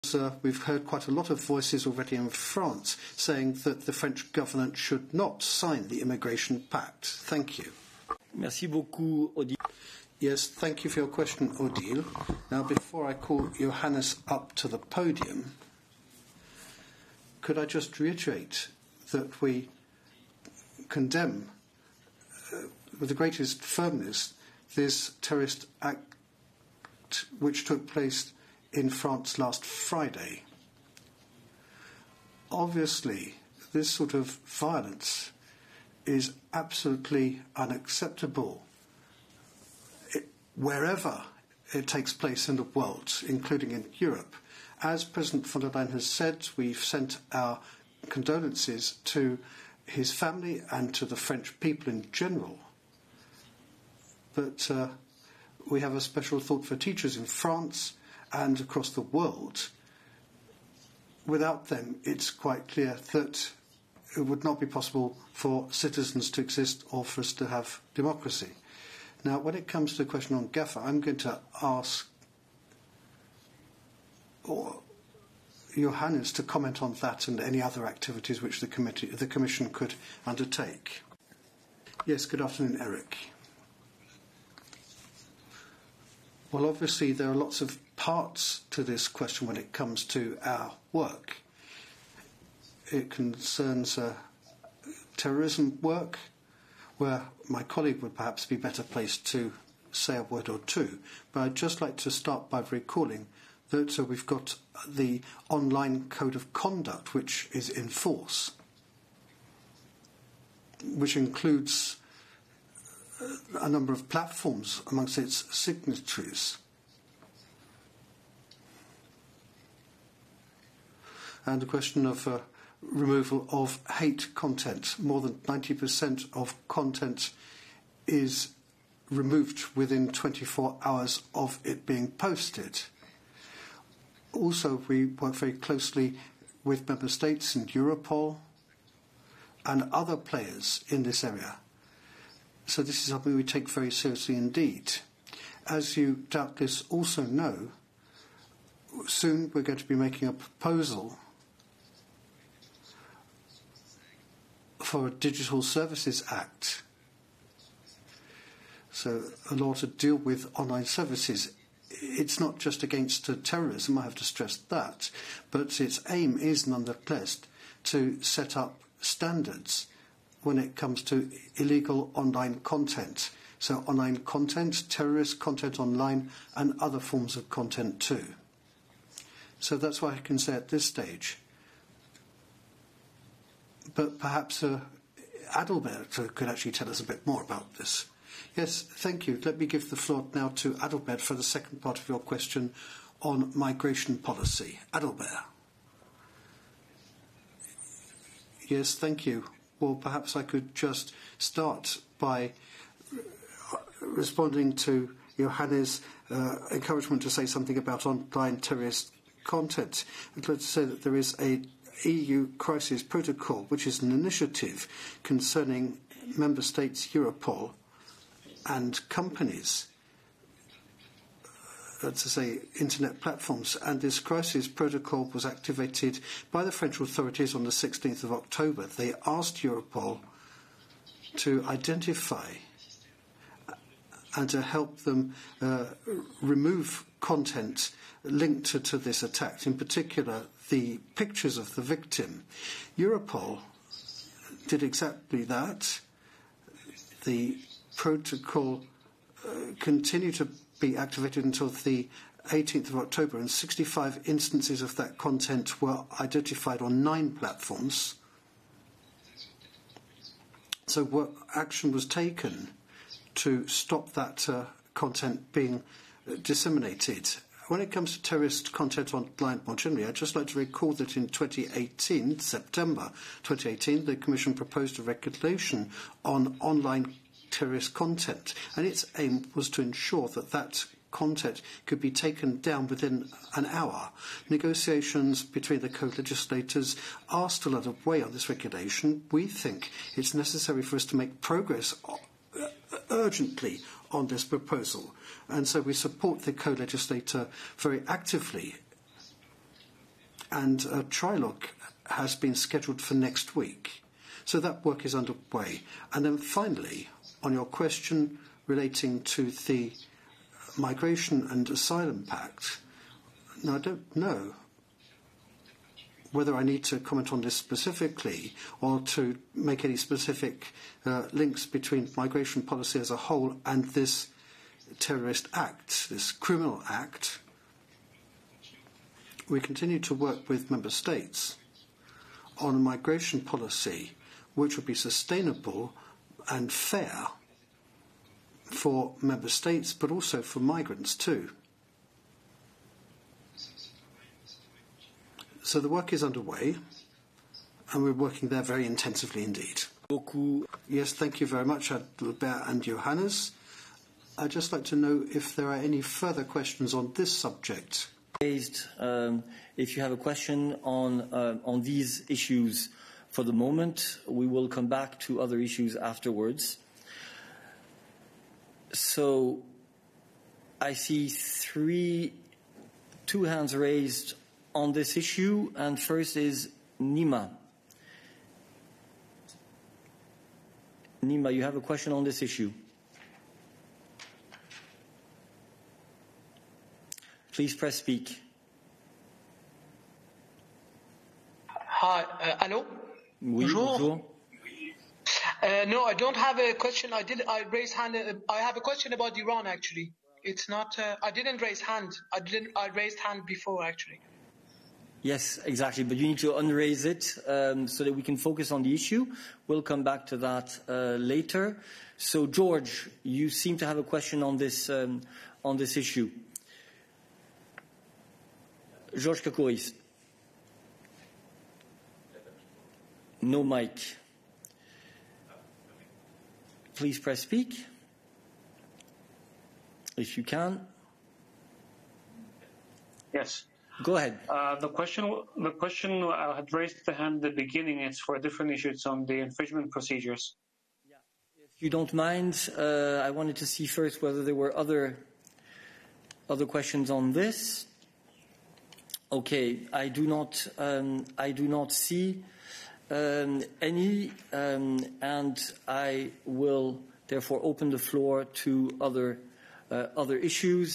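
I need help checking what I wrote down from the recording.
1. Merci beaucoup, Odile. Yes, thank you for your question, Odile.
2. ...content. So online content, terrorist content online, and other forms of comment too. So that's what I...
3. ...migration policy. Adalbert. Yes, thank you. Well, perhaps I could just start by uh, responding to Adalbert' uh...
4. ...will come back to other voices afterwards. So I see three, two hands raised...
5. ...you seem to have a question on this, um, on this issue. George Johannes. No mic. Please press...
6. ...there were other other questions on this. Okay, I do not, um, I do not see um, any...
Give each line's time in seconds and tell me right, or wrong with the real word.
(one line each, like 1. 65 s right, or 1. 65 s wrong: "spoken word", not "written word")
1. 8 s right
2. 172 s wrong: "content", not "comment"
3. 193 s wrong: "Johannes", not "Adalbert"
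4. 364 s wrong: "issues", not "voices"
5. 413 s wrong: "Kakouris", not "Johannes"
6. 444 s right.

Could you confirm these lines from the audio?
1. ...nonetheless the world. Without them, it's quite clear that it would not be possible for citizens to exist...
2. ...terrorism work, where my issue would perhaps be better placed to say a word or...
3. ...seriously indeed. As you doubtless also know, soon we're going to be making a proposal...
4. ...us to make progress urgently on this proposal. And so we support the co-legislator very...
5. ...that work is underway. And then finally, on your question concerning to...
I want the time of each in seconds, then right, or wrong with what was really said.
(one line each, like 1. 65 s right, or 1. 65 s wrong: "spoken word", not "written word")
1. 58 s wrong: "across", not "nonetheless"
2. 95 s wrong: "colleague", not "issue"
3. 143 s right
4. 290 s right
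5. 304 s wrong: "relating", not "concerning".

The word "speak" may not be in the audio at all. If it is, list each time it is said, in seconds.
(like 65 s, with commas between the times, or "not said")
387 s, 427 s.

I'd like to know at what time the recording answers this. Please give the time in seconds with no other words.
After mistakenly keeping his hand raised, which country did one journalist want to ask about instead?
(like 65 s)
399 s.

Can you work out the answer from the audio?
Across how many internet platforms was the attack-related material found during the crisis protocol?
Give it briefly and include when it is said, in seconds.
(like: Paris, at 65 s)
9, at 257 s.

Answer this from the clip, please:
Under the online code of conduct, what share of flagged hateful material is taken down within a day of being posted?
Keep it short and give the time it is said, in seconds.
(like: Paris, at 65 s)
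More than 90%, at 124 s.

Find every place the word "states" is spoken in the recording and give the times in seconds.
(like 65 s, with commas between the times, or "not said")
137 s, 216 s, 330 s, 339 s.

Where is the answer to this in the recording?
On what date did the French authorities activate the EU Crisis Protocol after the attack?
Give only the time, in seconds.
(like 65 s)
227 s.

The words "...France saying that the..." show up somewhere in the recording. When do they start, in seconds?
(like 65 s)
2 s.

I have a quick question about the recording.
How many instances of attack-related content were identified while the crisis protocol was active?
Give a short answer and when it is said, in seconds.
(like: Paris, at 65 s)
65, at 253 s.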